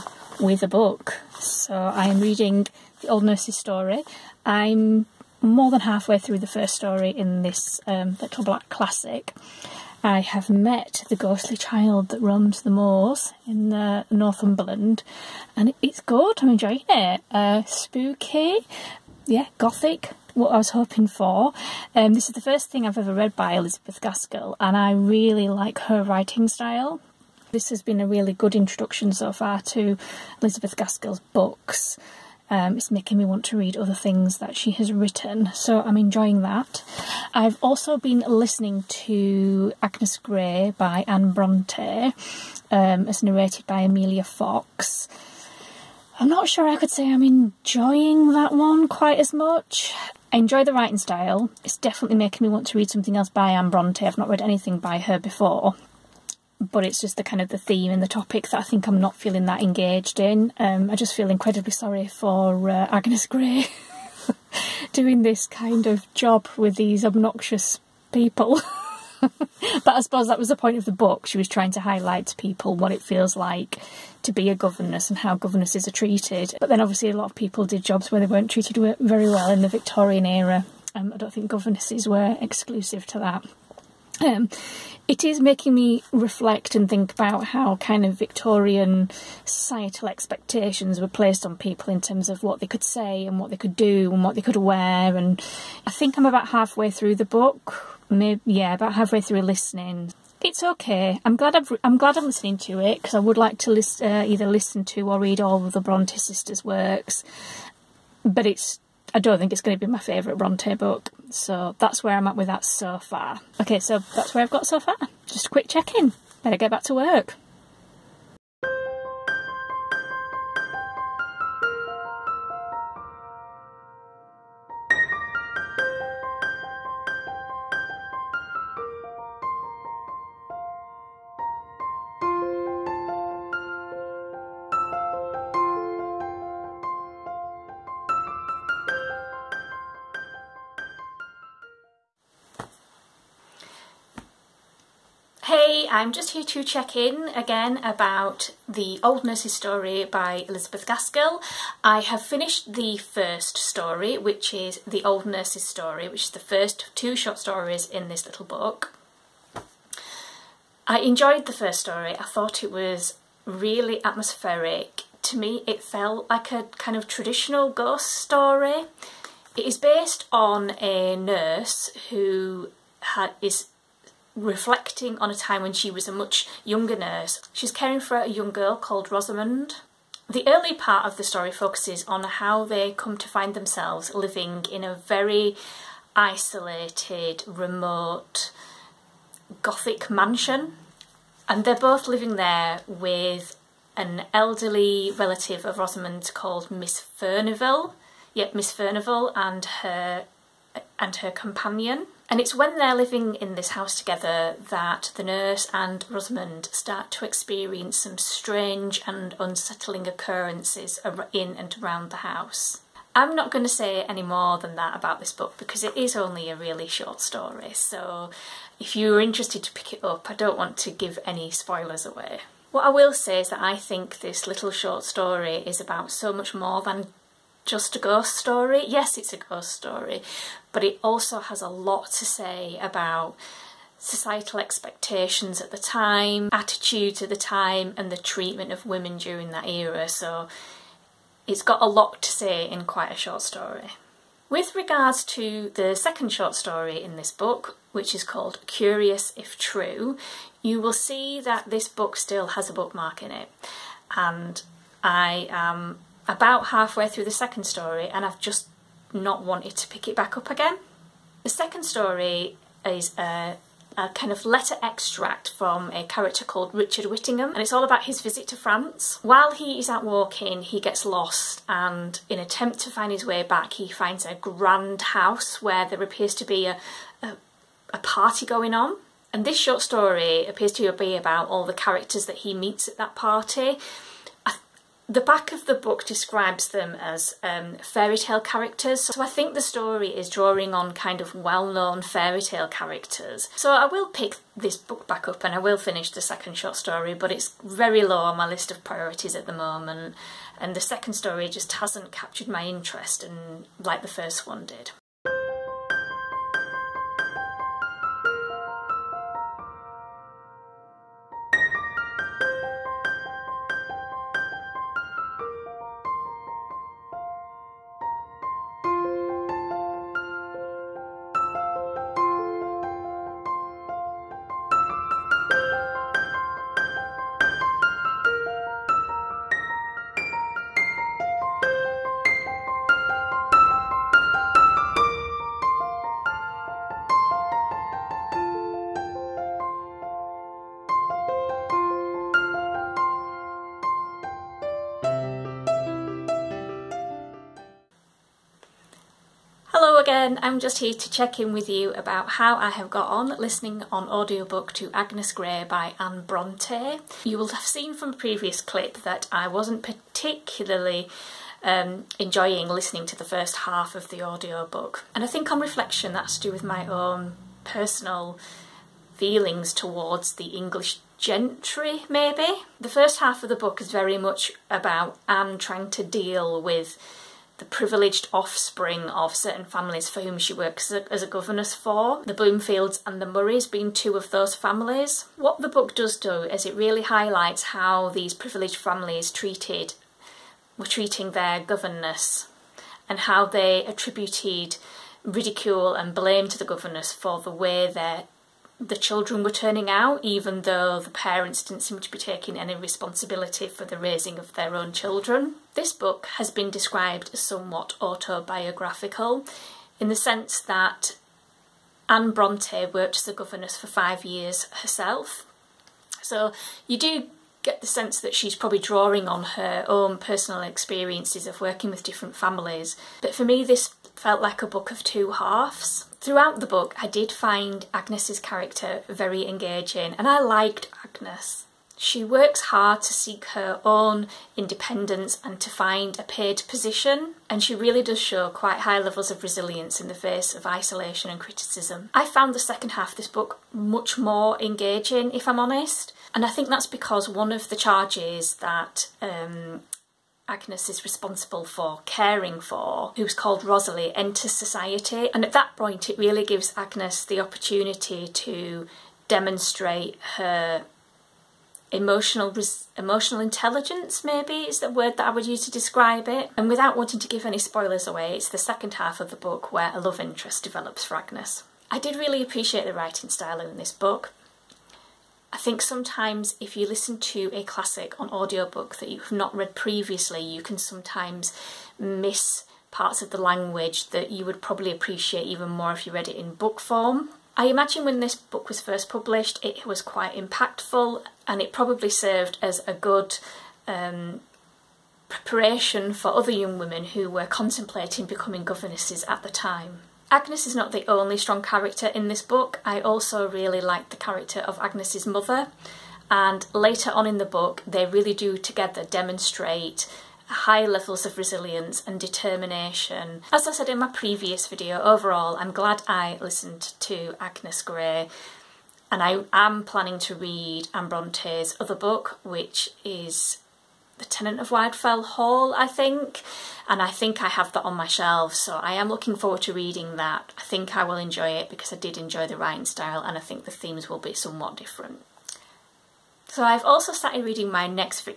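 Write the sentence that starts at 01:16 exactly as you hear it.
But then obviously a lot of people did jobs where they weren't treated very well in the Victorian era.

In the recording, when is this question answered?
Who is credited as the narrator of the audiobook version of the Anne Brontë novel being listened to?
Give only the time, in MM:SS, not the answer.
00:43.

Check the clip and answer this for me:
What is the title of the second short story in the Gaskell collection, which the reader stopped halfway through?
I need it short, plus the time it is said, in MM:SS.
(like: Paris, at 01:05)
Curious If True, at 04:08.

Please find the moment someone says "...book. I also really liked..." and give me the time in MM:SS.
08:22.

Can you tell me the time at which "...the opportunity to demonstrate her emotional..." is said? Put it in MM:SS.
07:37.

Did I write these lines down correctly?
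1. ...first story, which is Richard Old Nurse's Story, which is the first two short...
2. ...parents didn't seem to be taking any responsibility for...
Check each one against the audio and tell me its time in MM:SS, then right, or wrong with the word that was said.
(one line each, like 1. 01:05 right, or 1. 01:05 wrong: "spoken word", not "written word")
1. 02:32 wrong: "The", not "Richard"
2. 06:41 right.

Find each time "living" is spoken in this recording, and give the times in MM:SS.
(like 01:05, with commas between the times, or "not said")
03:04, 03:12, 03:22.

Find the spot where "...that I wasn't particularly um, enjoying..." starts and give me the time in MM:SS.
05:59.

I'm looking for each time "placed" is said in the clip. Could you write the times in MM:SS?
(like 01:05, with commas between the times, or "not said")
01:31.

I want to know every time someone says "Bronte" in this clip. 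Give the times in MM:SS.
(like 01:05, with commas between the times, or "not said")
00:41, 00:53, 01:45, 01:50, 05:56, 06:52, 08:41.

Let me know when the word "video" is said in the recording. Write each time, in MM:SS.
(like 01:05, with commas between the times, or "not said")
08:34.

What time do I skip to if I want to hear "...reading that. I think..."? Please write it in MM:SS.
08:49.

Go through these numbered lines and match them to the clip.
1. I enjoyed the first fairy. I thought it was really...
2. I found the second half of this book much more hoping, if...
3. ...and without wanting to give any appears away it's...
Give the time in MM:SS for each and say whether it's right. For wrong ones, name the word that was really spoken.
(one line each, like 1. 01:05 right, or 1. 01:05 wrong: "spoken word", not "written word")
1. 02:40 wrong: "story", not "fairy"
2. 07:22 wrong: "engaging", not "hoping"
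3. 07:46 wrong: "spoilers", not "appears".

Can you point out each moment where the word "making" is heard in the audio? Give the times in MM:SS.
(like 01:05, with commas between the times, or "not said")
00:32, 00:52, 01:25.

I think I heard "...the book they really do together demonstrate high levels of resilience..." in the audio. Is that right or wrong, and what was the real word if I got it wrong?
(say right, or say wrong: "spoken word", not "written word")
right.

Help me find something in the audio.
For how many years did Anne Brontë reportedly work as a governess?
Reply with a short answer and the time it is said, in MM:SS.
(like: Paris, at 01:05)
5, at 06:53.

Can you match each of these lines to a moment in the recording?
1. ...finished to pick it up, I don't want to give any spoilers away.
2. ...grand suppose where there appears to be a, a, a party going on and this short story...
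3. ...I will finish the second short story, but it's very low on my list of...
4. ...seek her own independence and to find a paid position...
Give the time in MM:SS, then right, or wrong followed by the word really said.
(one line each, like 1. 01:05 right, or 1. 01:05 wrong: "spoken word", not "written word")
1. 03:39 wrong: "interested", not "finished"
2. 04:34 wrong: "house", not "suppose"
3. 04:55 right
4. 07:13 right.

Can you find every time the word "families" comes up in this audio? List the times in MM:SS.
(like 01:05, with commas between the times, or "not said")
06:19, 06:24, 06:28, 07:02.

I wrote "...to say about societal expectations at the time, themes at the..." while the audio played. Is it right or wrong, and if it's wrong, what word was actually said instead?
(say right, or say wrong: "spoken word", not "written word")
wrong: "attitudes", not "themes".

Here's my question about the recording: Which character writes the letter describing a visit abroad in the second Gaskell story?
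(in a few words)
Richard Whittingham.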